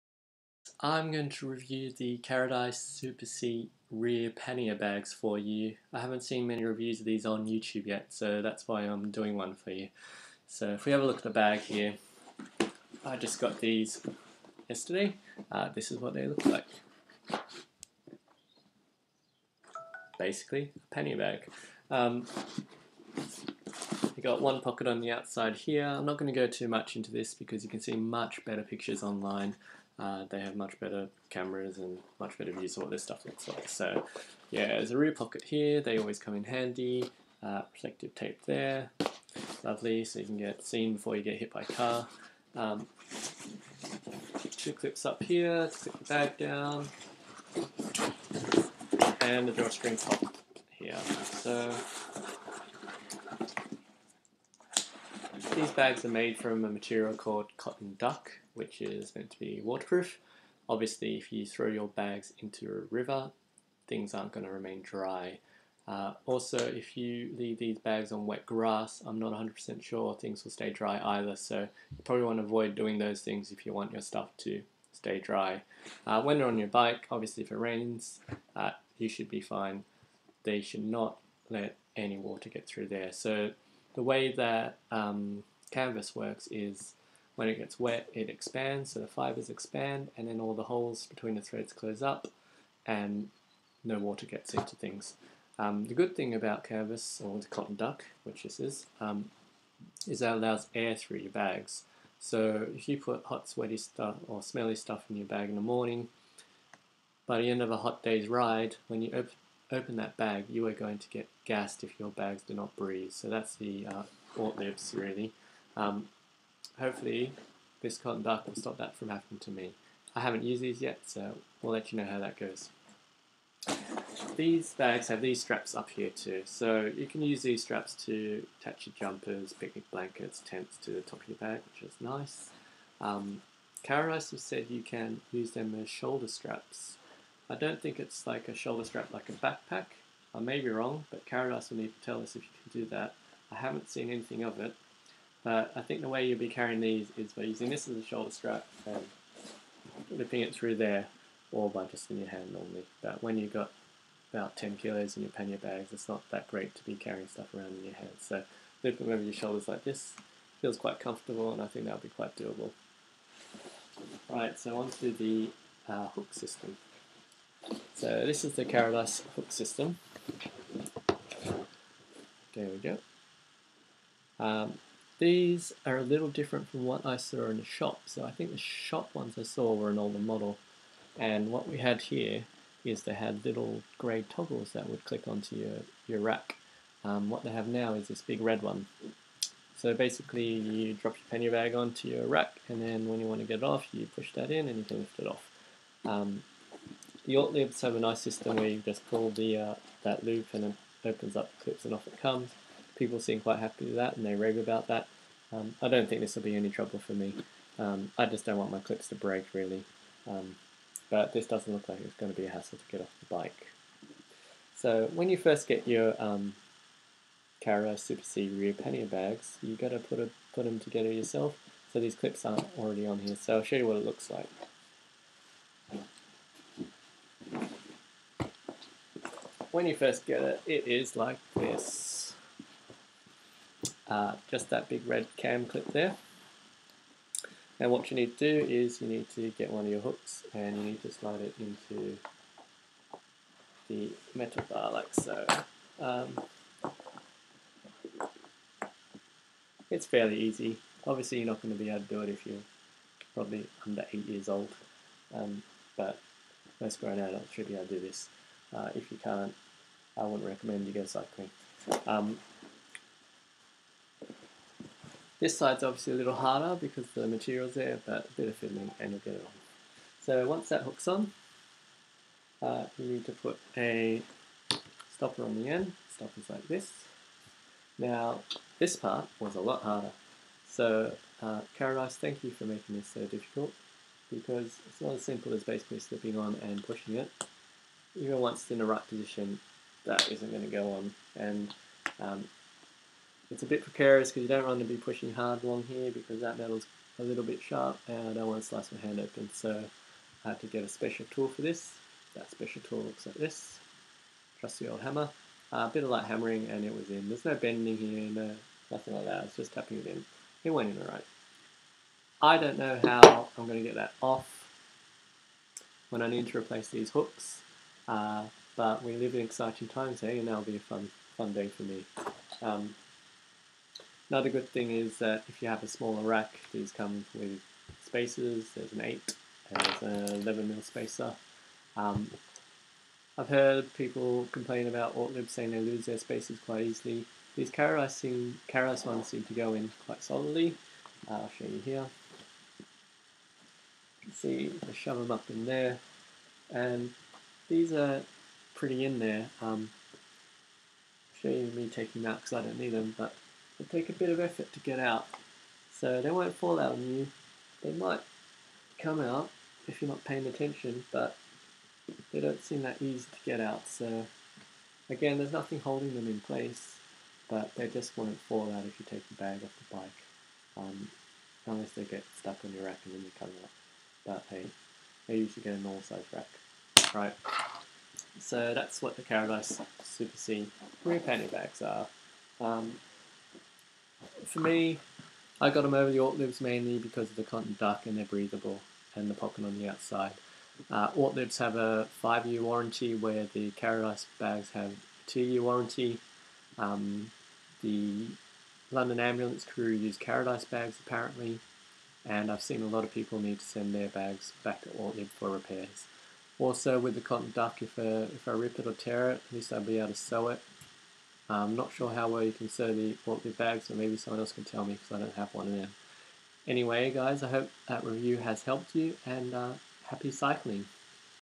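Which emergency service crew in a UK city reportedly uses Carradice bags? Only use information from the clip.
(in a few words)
London ambulance crew.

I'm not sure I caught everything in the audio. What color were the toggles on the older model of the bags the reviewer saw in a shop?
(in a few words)
Grey.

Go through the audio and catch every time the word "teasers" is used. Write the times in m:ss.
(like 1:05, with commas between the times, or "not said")
not said.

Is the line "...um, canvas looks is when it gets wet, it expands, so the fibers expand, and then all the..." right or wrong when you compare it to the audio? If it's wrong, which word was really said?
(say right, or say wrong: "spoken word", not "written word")
wrong: "works", not "looks".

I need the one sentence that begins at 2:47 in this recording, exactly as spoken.
So this is the Carradice hook system.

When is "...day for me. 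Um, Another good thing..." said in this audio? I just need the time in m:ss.
5:21.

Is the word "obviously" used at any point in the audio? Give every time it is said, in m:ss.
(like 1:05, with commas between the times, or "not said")
1:00, 1:17, 4:11, 4:25.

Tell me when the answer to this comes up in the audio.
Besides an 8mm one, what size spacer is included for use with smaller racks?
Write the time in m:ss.
5:30.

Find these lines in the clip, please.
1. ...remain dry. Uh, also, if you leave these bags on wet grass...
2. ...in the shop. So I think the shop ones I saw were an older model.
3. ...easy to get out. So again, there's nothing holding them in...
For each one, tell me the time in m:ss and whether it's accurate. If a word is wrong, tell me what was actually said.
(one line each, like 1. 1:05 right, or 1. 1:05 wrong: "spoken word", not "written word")
1. 1:04 right
2. 2:57 right
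3. 6:03 right.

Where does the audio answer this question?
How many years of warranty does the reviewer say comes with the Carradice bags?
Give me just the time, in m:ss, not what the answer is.
6:35.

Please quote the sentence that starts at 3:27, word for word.
Um, I just don't want my clips to break really.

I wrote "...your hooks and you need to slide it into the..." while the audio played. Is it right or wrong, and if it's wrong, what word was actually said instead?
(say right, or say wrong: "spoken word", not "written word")
right.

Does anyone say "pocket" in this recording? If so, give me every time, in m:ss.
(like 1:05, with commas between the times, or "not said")
0:24, 0:35, 6:29.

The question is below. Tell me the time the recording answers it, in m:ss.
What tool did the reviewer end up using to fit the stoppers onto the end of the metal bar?
5:04.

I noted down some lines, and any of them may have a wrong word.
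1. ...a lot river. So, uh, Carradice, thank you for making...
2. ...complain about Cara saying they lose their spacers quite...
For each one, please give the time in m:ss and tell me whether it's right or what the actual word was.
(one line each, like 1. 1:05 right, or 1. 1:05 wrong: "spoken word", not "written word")
1. 4:39 wrong: "harder", not "river"
2. 5:34 wrong: "Ortlieb", not "Cara".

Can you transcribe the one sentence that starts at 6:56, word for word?
Anyway, guys, I hope that review has helped you, and uh, happy cycling.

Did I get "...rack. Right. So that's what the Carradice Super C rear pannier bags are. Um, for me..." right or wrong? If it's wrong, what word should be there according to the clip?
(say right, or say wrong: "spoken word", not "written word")
right.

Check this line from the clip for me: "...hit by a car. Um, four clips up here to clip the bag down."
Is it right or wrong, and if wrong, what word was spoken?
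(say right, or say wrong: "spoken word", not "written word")
wrong: "two", not "four".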